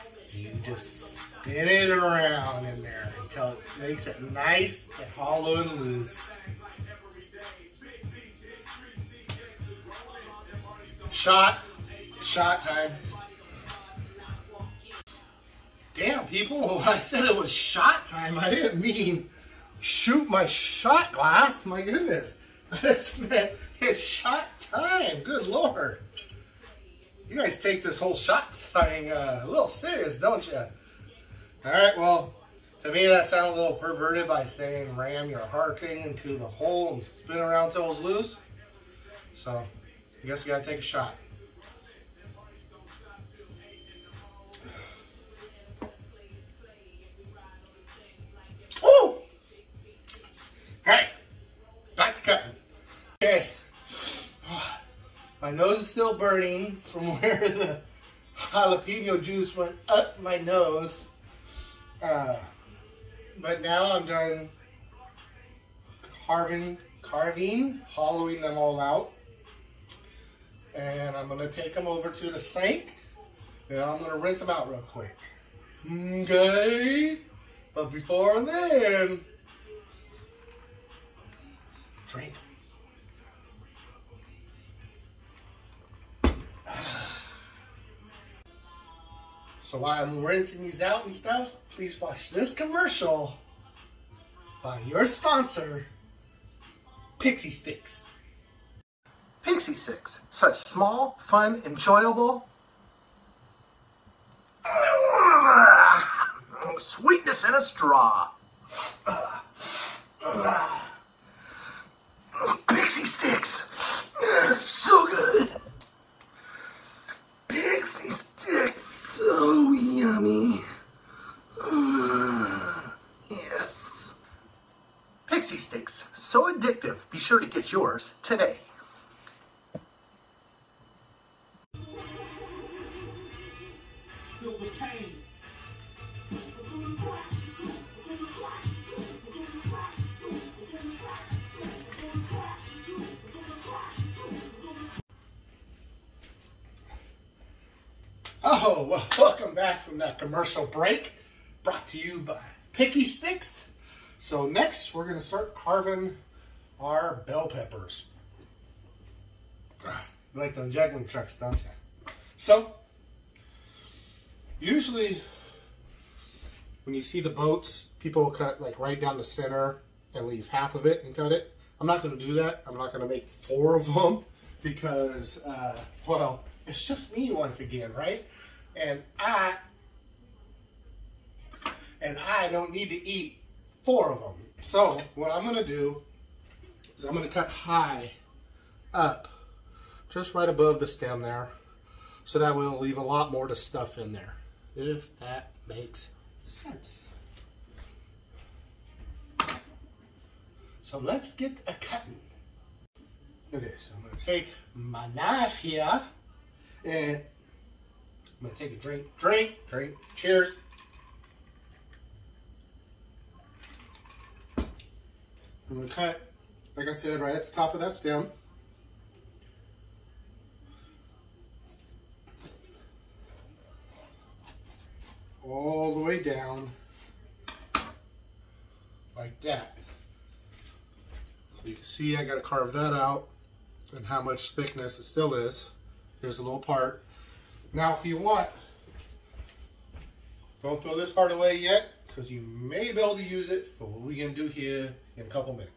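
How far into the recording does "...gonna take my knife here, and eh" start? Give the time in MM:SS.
03:24.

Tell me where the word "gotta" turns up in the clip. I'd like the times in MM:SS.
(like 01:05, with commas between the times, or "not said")
00:40, 03:52.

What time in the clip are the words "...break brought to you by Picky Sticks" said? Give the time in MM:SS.
02:30.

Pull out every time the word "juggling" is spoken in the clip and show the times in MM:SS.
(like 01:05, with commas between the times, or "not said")
02:40.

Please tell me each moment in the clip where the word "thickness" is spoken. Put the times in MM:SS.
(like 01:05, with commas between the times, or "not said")
03:54.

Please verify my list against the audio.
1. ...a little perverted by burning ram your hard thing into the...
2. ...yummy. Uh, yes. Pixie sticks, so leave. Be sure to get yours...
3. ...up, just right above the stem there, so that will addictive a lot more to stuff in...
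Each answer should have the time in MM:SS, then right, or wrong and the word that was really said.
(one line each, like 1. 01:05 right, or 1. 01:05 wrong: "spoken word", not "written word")
1. 00:33 wrong: "saying", not "burning"
2. 01:59 wrong: "addictive", not "leave"
3. 03:08 wrong: "leave", not "addictive".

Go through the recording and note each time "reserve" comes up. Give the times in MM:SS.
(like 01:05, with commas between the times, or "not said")
not said.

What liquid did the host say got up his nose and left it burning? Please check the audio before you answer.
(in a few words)
Jalapeno juice.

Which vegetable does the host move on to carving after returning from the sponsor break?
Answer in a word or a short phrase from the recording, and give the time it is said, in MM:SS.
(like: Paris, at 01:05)
Bell peppers, at 02:37.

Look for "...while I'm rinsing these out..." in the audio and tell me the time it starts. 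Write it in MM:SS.
01:29.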